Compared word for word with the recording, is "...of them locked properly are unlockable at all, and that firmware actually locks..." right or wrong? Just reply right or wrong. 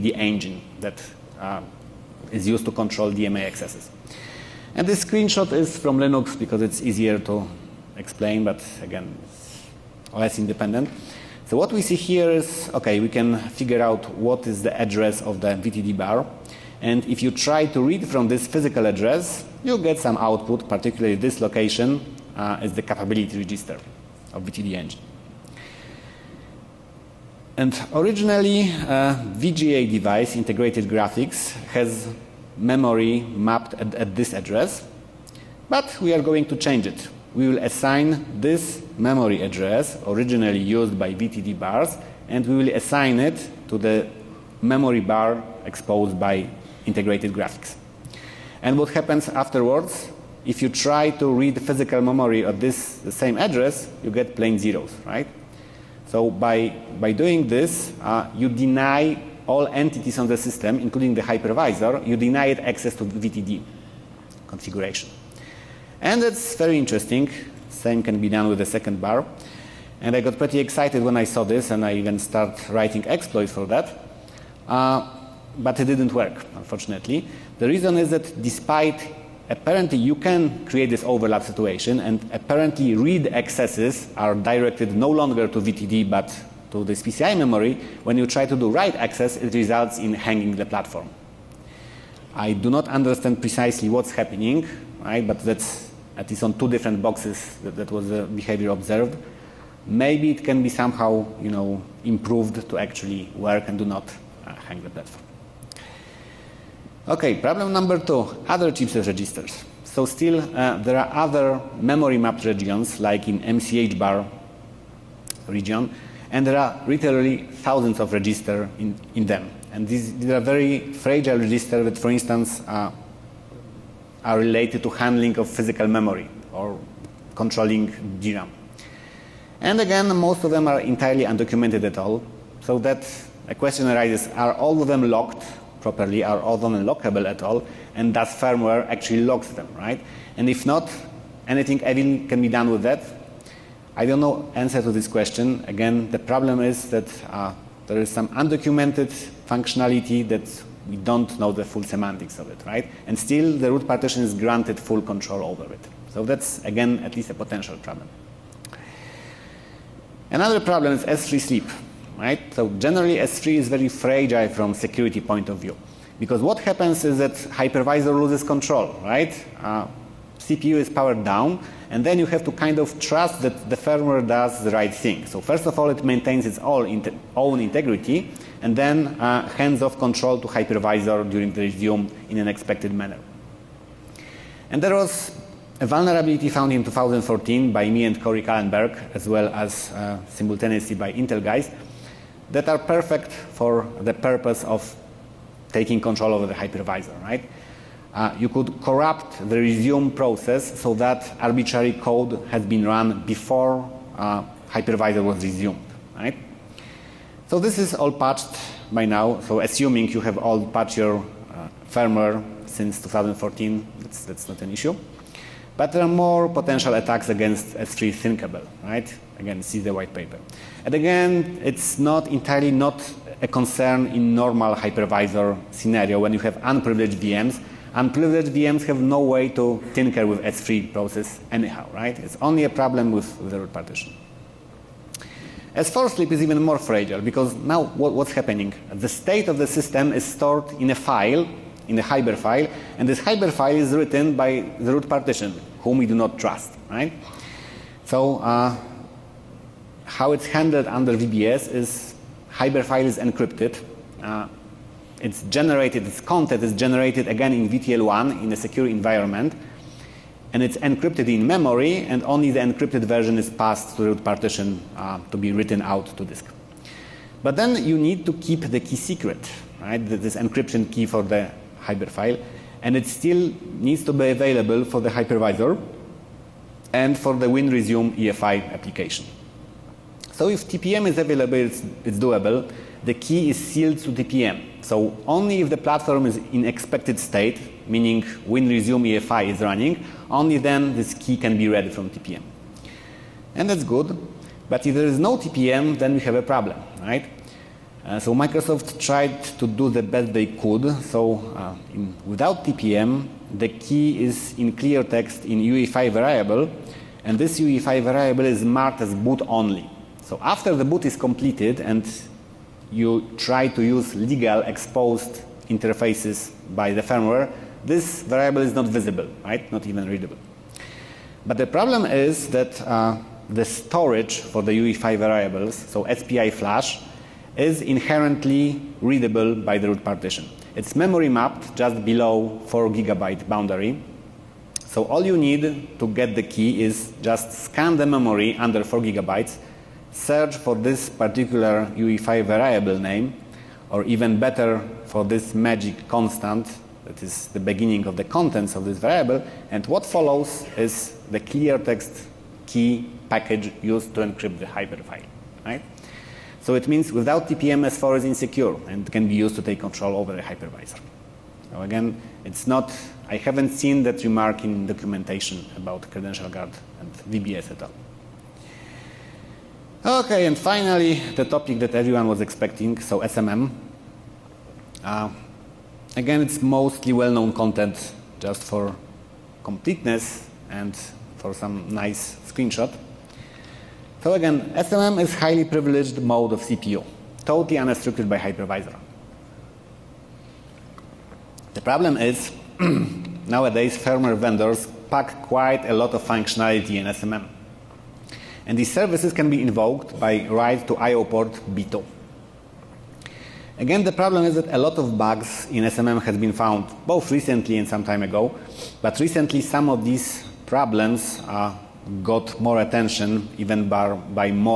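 right.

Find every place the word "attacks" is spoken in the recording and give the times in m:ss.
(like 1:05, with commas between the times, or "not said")
3:36.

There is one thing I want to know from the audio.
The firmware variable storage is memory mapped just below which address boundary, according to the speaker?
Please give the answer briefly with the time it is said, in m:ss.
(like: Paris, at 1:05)
4 gigabytes, at 5:32.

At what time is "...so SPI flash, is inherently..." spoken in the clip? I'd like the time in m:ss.
5:25.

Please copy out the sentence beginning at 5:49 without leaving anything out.
And what follows is the clear text key package used to encrypt the hiberfile, right?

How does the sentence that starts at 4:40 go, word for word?
So if TPM is available, it's, it's doable.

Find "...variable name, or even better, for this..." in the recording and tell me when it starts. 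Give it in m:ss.
5:42.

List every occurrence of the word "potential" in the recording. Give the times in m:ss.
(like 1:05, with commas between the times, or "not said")
2:37, 3:36.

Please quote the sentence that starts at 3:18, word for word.
Uh, you could corrupt the resume process so that arbitrary code has been run before uh, hypervisor was resumed, right?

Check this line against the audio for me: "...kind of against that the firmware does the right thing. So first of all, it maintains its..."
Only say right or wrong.
wrong.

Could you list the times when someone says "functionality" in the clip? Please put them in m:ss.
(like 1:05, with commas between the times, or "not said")
2:29, 6:36.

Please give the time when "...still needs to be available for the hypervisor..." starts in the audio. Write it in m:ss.
4:33.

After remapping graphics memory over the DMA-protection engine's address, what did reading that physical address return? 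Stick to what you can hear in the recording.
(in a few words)
plain zeros.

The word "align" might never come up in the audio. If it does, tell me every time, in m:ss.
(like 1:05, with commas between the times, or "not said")
not said.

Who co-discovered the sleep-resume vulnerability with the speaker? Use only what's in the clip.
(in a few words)
Corey Kallenberg.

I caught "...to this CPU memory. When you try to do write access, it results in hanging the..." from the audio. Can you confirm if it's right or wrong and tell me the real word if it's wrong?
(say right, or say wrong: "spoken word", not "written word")
wrong: "PCI", not "CPU".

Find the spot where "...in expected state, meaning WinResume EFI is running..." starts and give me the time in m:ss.
4:46.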